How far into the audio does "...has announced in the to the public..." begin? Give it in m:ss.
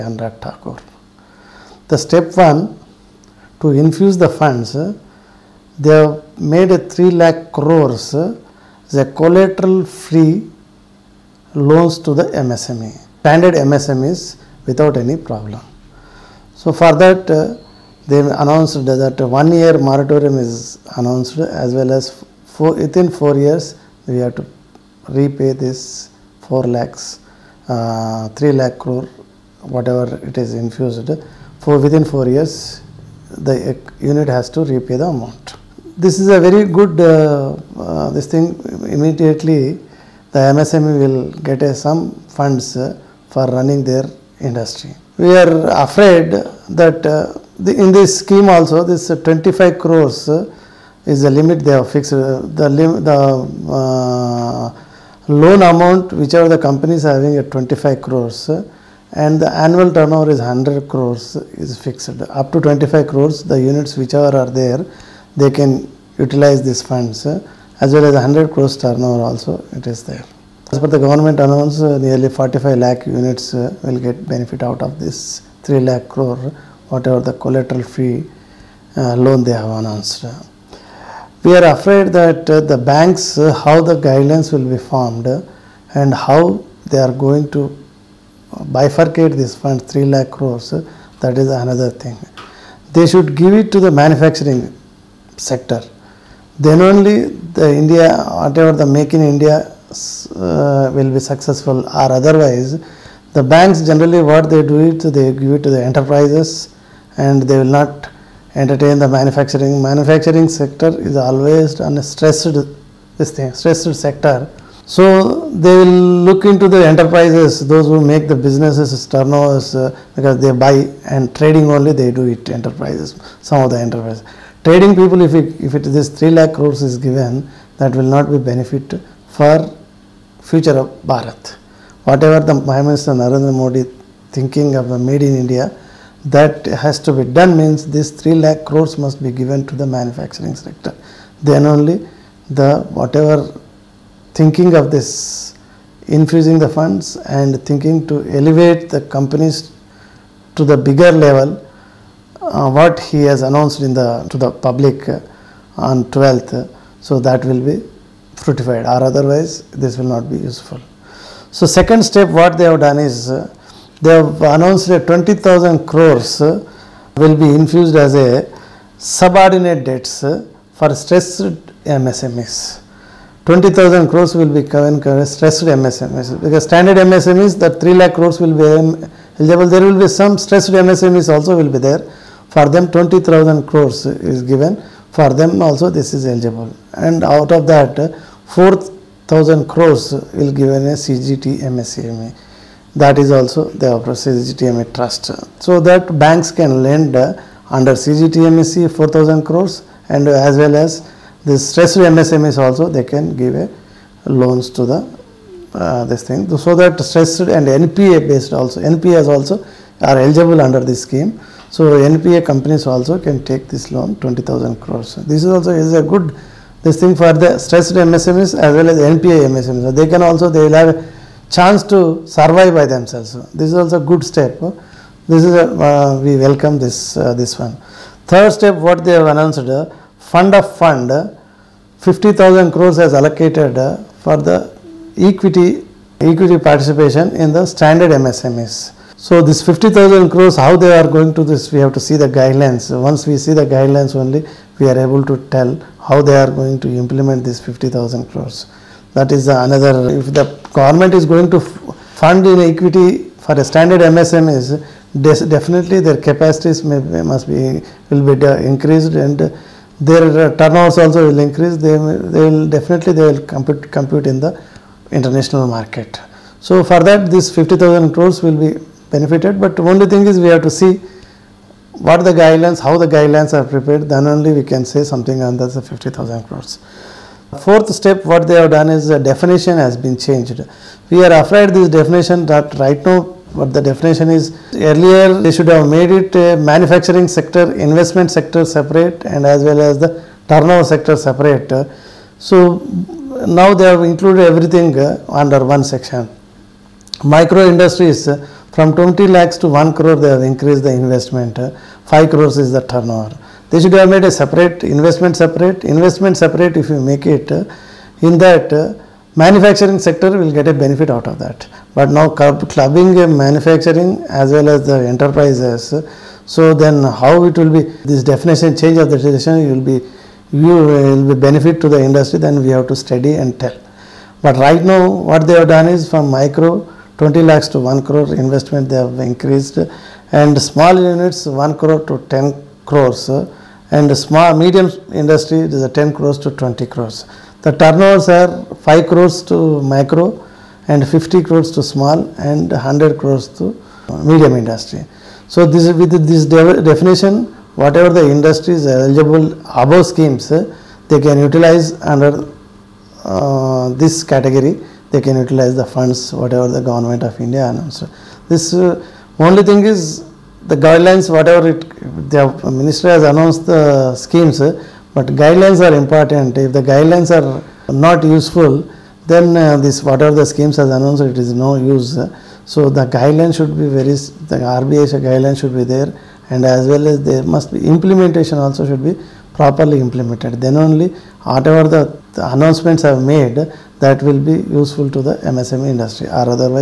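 2:33.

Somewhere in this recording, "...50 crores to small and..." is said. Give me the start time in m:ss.
5:41.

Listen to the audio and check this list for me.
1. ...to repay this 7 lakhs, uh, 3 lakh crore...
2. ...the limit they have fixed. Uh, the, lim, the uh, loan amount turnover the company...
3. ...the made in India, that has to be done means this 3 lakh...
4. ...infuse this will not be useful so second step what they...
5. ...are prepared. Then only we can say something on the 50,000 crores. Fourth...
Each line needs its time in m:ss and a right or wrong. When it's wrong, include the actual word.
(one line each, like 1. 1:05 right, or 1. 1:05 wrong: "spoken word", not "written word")
1. 0:24 wrong: "4", not "7"
2. 0:51 wrong: "whichever", not "turnover"
3. 2:14 right
4. 2:39 wrong: "otherwise", not "infuse"
5. 4:33 right.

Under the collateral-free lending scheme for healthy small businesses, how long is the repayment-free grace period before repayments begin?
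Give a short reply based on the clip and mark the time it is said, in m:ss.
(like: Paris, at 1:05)
1 year, at 0:19.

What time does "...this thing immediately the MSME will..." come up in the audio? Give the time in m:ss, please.
0:38.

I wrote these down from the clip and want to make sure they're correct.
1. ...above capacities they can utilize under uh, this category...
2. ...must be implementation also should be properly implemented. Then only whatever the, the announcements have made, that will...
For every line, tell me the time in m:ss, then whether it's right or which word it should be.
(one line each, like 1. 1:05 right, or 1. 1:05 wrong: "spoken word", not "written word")
1. 5:49 wrong: "schemes", not "capacities"
2. 6:17 right.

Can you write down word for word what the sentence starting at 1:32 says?
They should give it to the manufacturing sector.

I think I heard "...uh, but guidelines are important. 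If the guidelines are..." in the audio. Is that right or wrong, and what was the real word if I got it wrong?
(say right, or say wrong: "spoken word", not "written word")
right.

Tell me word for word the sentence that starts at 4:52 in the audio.
So now they have included everything uh, under one section.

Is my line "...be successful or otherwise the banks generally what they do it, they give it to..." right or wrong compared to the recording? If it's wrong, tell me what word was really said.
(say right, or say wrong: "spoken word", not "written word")
right.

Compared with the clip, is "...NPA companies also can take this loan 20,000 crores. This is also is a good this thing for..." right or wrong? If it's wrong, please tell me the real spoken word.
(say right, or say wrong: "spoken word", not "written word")
right.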